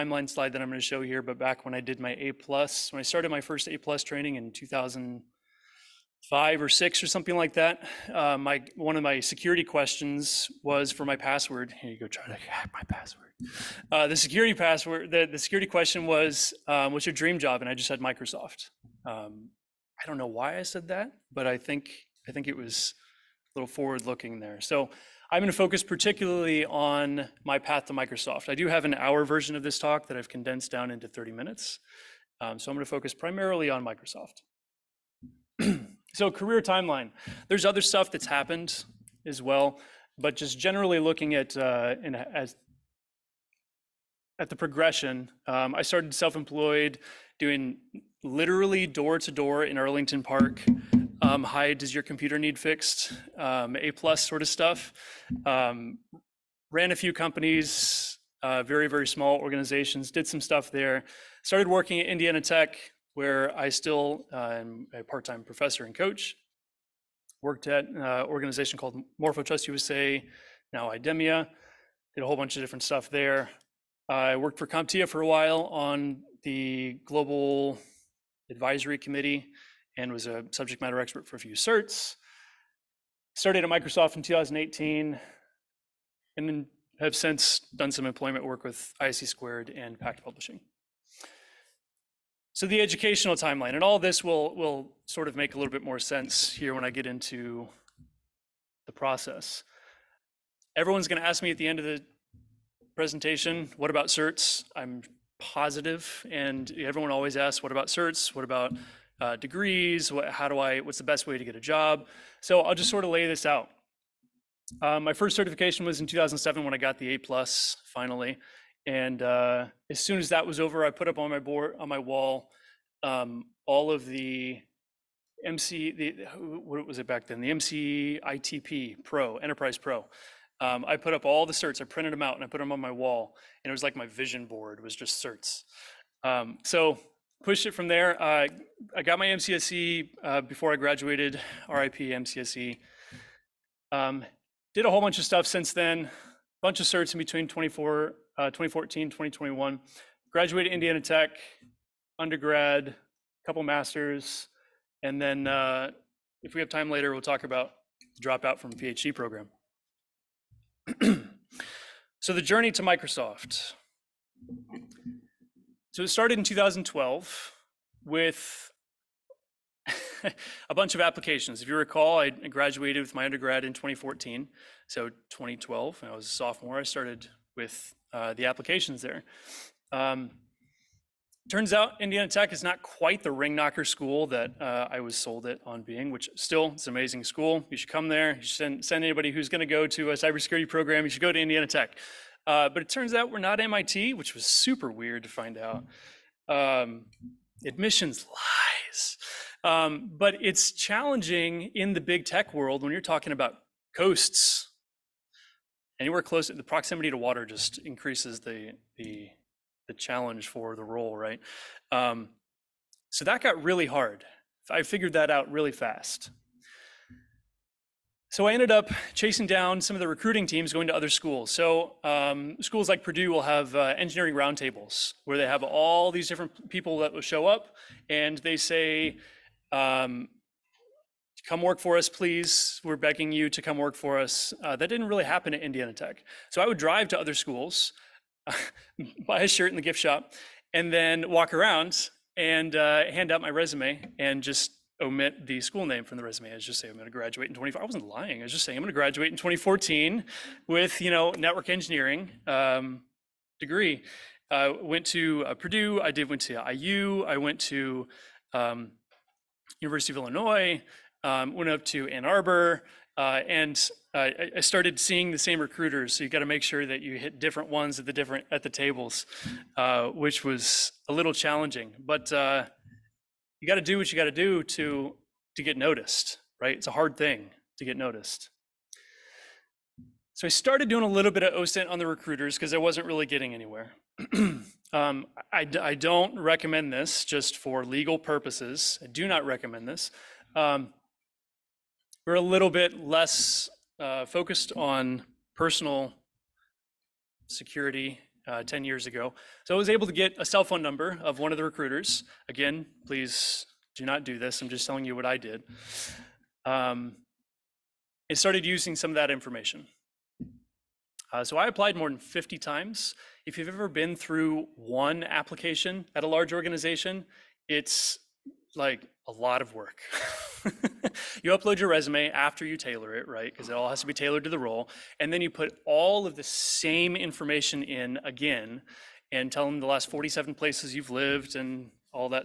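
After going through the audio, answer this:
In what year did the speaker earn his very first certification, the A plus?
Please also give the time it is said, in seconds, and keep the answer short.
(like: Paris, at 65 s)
2007, at 116 s.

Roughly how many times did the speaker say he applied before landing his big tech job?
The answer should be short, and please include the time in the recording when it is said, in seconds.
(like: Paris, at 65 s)
more than 50, at 311 s.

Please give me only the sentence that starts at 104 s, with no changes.
I'm positive, and everyone always asks, "What about certs?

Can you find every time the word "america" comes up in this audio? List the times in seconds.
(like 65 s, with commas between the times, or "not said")
not said.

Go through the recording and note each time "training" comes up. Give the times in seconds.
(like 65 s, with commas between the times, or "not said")
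4 s.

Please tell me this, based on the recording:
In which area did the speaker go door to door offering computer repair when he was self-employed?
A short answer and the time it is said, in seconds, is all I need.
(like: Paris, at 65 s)
Arlington Park, at 49 s.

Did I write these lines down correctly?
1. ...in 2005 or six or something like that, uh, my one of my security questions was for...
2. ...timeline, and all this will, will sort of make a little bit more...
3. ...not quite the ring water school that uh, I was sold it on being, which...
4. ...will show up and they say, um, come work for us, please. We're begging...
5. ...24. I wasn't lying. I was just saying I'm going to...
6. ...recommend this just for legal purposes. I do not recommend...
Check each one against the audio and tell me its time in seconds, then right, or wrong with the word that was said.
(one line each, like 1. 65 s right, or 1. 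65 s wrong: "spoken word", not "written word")
1. 4 s right
2. 93 s right
3. 182 s wrong: "knocker", not "water"
4. 227 s right
5. 247 s right
6. 286 s right.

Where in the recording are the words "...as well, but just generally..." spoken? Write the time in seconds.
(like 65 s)
39 s.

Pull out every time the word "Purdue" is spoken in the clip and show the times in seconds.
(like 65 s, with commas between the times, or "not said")
223 s, 255 s.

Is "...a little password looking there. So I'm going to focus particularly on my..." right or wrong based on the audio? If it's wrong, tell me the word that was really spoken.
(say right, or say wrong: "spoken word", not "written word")
wrong: "forward", not "password".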